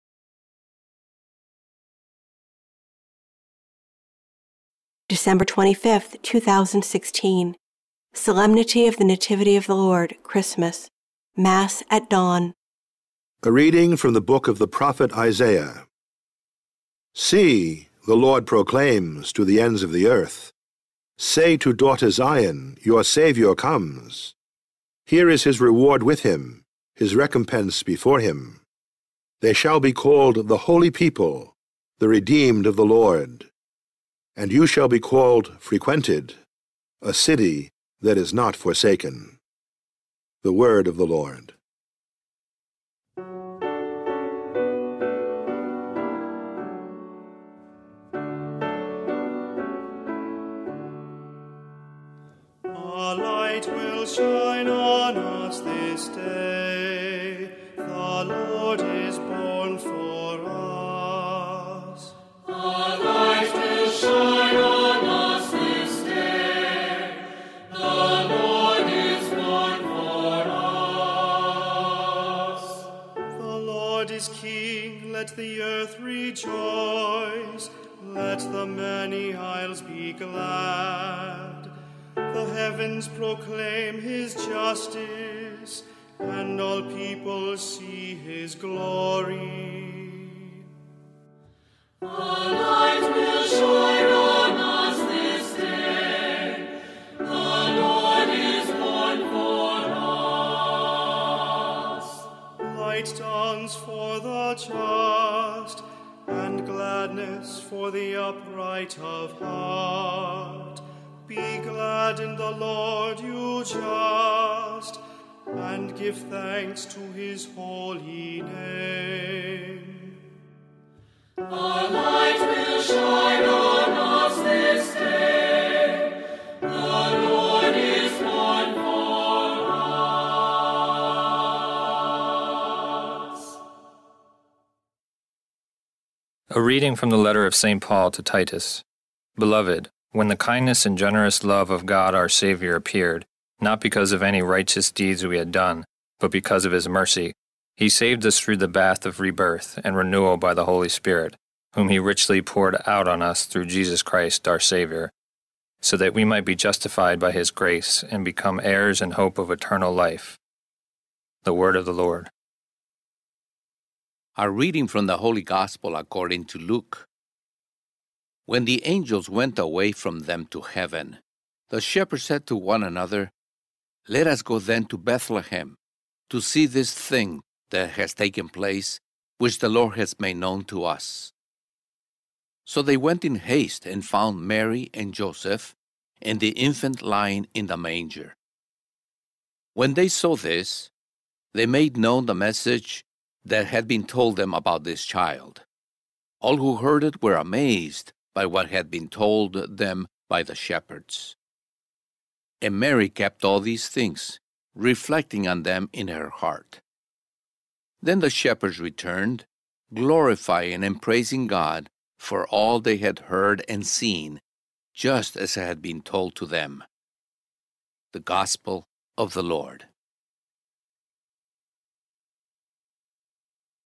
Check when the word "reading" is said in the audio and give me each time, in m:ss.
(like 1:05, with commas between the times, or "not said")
0:13, 2:16, 2:44.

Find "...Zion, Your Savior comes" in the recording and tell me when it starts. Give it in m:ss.
0:22.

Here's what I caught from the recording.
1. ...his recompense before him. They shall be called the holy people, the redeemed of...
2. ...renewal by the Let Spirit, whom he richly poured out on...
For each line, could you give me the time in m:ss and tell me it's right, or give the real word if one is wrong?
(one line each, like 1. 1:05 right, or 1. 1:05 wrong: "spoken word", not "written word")
1. 0:26 right
2. 2:29 wrong: "Holy", not "Let".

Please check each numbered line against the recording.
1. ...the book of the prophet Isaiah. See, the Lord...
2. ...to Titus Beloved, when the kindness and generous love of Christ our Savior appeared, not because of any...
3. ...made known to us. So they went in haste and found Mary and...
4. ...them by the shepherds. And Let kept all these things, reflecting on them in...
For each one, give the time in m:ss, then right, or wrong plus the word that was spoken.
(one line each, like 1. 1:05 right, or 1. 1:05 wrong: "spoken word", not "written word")
1. 0:14 right
2. 2:18 wrong: "God", not "Christ"
3. 3:00 right
4. 3:19 wrong: "Mary", not "Let".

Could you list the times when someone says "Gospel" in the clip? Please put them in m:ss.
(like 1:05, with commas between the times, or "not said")
2:45, 3:38.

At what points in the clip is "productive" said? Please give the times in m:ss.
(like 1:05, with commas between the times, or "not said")
not said.